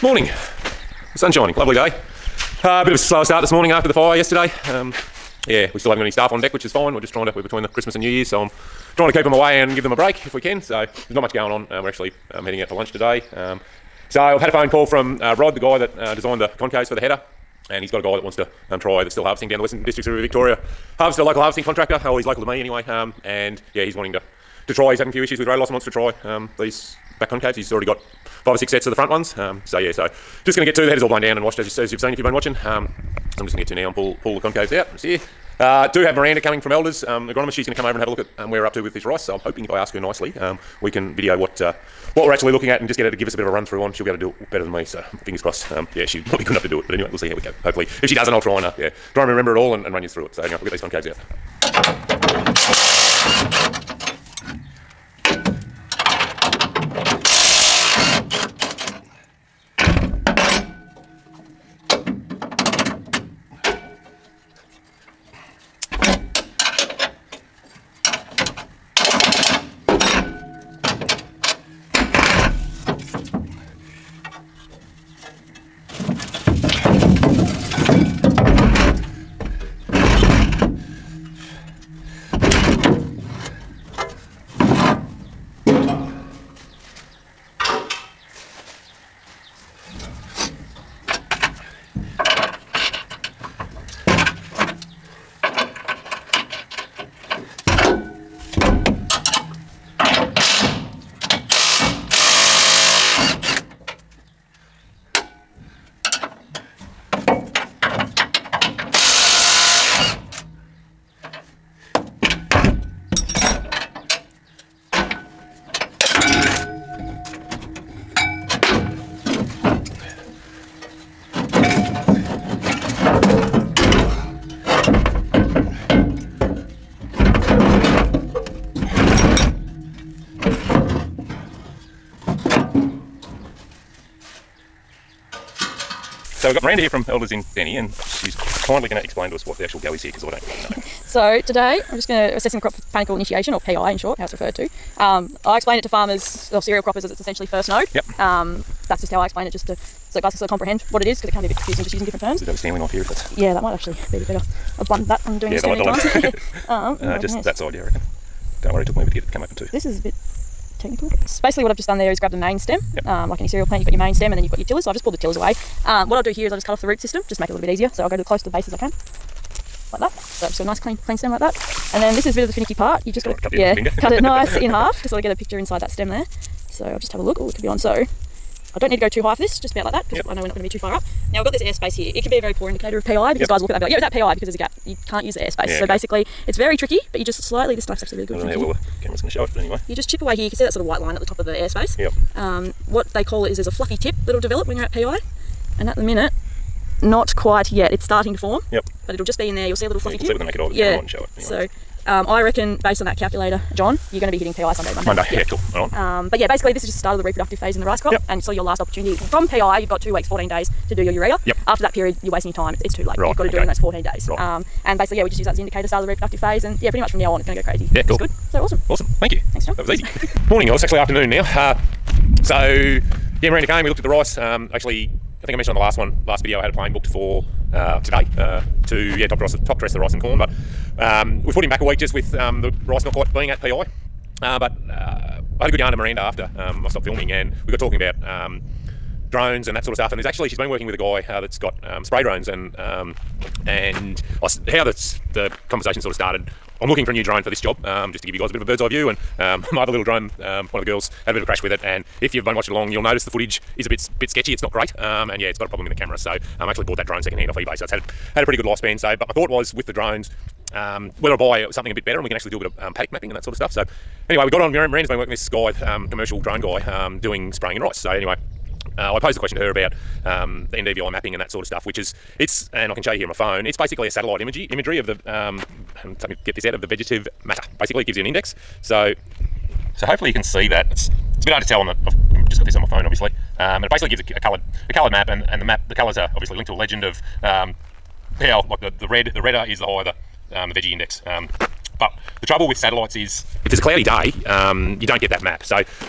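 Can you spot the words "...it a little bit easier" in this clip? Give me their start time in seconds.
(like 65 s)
167 s.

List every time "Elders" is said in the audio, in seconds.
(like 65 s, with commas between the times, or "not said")
36 s, 137 s.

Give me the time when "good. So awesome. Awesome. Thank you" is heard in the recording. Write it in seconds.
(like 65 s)
218 s.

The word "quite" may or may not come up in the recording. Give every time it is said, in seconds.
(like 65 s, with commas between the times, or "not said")
197 s, 233 s.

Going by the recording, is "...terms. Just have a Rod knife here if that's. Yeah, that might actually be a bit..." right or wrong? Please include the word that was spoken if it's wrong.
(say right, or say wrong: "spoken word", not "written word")
wrong: "Stanley", not "Rod".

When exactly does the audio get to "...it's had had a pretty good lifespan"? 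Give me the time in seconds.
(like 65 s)
257 s.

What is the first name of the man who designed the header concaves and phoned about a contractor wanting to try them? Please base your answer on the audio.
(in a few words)
Rod.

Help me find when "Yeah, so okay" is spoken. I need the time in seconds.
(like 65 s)
185 s.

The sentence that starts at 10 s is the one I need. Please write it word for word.
So there's not much going on.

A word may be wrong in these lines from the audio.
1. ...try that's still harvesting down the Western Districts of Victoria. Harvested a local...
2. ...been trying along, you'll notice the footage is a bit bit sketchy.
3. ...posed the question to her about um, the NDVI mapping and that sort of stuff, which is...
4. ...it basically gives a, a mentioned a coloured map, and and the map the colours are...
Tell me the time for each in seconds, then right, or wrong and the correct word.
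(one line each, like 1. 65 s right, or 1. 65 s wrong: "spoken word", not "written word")
1. 18 s right
2. 252 s wrong: "watching", not "trying"
3. 269 s right
4. 283 s wrong: "coloured", not "mentioned".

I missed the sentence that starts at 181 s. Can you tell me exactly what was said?
Now we've got this airspace here.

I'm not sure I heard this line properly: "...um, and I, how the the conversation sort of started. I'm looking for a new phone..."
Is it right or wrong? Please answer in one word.
wrong.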